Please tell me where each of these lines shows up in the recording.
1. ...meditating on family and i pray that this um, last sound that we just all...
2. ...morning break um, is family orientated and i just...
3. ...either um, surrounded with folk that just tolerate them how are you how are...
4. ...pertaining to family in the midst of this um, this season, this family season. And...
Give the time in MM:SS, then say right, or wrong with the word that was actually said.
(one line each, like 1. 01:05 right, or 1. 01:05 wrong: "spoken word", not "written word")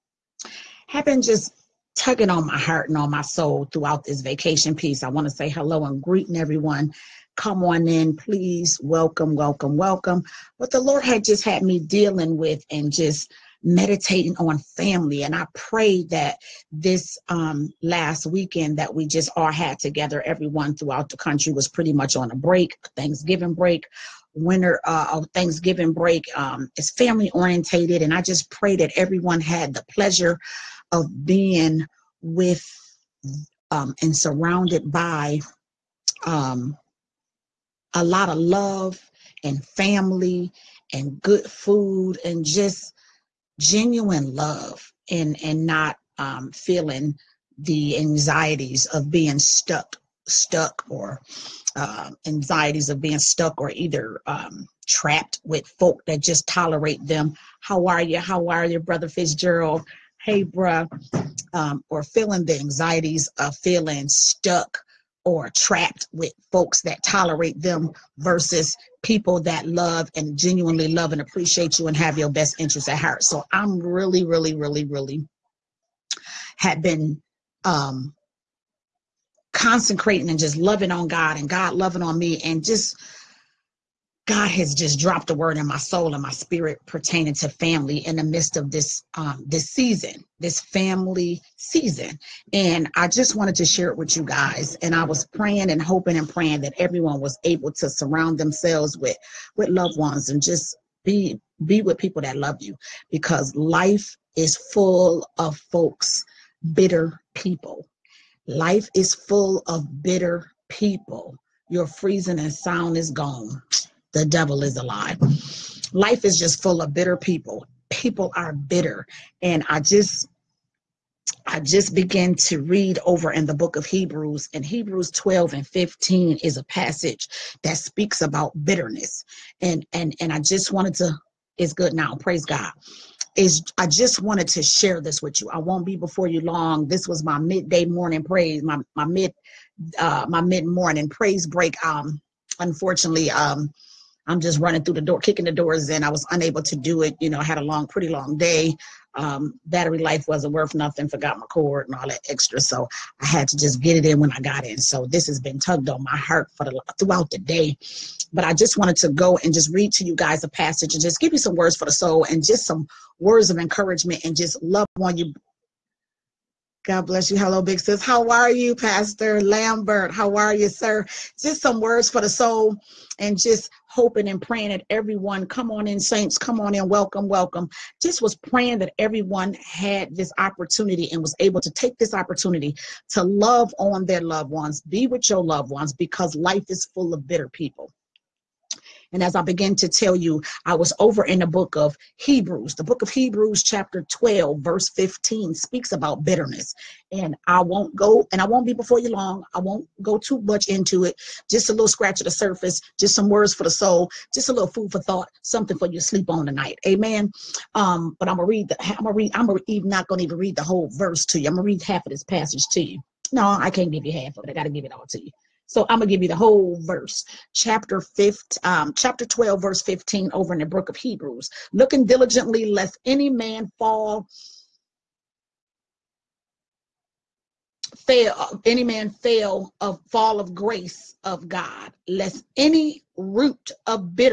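1. 00:13 wrong: "weekend", not "sound"
2. 00:25 wrong: "thanksgiving", not "morning"
3. 00:53 wrong: "trapped", not "surrounded"
4. 01:26 right.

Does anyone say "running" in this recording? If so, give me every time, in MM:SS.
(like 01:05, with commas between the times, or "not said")
02:24.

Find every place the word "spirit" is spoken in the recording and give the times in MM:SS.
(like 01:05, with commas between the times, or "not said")
01:26.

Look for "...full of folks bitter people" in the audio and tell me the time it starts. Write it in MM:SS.
01:44.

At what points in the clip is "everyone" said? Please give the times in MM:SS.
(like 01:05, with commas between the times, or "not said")
00:06, 00:20, 00:28, 01:36, 02:54, 02:58.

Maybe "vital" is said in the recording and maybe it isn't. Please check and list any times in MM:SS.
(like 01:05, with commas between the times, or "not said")
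not said.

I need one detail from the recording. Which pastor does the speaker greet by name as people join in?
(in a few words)
Pastor Lambert.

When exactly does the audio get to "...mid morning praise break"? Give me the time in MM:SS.
02:20.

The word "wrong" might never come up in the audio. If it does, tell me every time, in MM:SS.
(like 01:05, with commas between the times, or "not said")
not said.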